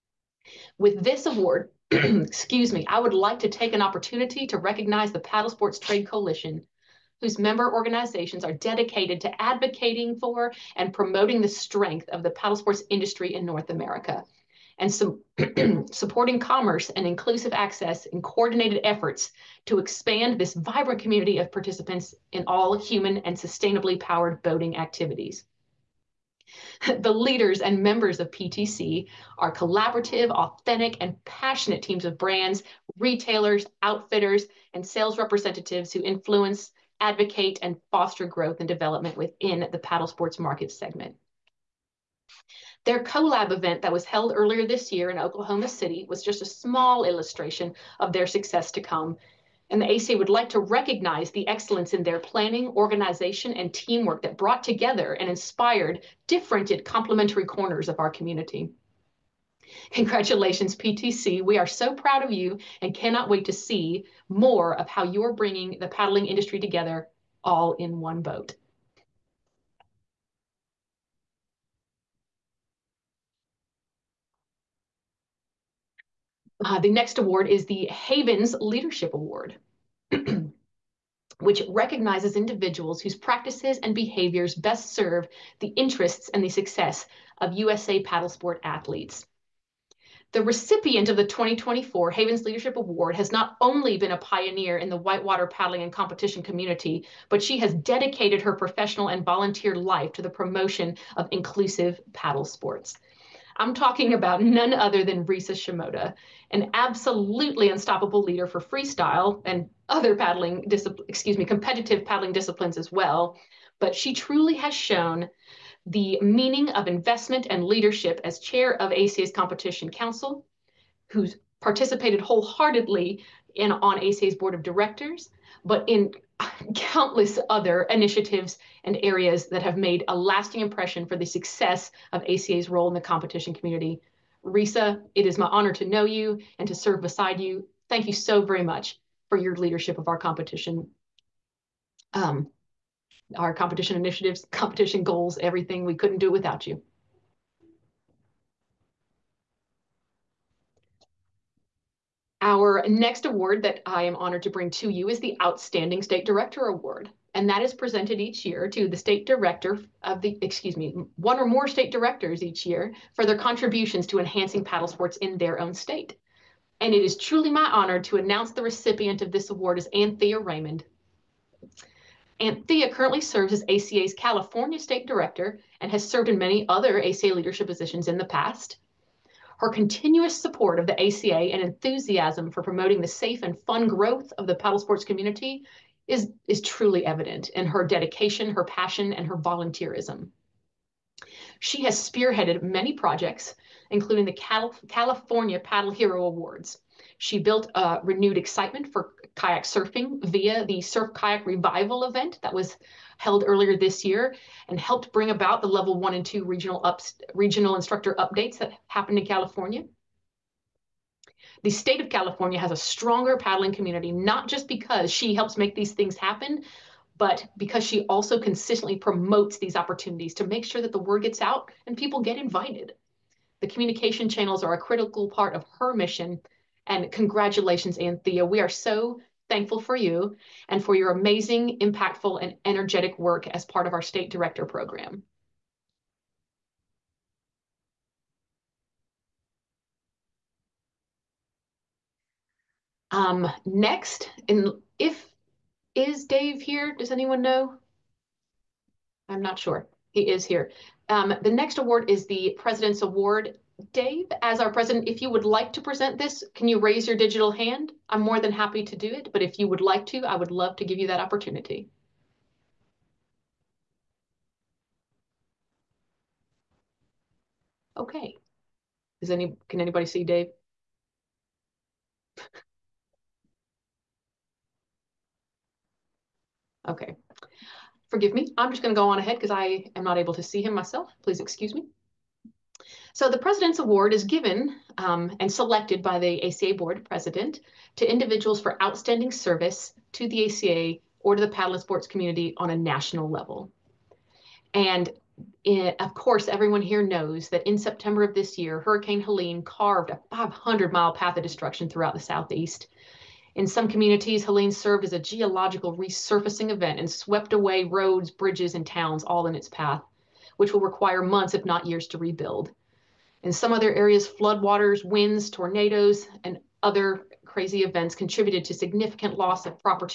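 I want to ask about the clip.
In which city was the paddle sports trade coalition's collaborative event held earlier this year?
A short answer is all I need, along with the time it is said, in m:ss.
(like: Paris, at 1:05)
Oklahoma City, at 0:45.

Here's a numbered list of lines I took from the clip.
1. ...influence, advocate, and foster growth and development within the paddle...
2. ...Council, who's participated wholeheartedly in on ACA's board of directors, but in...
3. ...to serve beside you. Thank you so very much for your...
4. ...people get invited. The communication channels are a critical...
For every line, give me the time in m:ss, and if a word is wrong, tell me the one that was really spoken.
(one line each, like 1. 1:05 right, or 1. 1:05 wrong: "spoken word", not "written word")
1. 0:36 right
2. 1:59 right
3. 2:16 right
4. 3:41 right.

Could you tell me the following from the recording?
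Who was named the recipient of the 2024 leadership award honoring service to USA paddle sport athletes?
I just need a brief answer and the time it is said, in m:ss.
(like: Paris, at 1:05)
Risa Shimoda, at 1:45.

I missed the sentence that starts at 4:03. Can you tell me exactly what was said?
Um, next, and if is Dave here?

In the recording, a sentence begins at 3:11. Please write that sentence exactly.
She has spearheaded many projects, including the Cal California Paddle Hero Awards.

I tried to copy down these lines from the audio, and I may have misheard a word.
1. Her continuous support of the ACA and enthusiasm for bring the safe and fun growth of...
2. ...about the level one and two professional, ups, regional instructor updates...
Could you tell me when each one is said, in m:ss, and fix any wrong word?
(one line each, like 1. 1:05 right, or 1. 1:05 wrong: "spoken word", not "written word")
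1. 2:59 wrong: "promoting", not "bring"
2. 3:25 wrong: "regional", not "professional".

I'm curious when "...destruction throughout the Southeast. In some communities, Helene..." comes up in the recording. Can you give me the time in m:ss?
5:01.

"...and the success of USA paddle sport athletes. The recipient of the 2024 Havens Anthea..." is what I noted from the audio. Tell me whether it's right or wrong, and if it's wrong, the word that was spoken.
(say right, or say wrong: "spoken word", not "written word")
wrong: "Leadership", not "Anthea".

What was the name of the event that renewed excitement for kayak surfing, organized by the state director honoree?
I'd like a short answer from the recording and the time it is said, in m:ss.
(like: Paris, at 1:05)
Surf Kayak Revival, at 3:20.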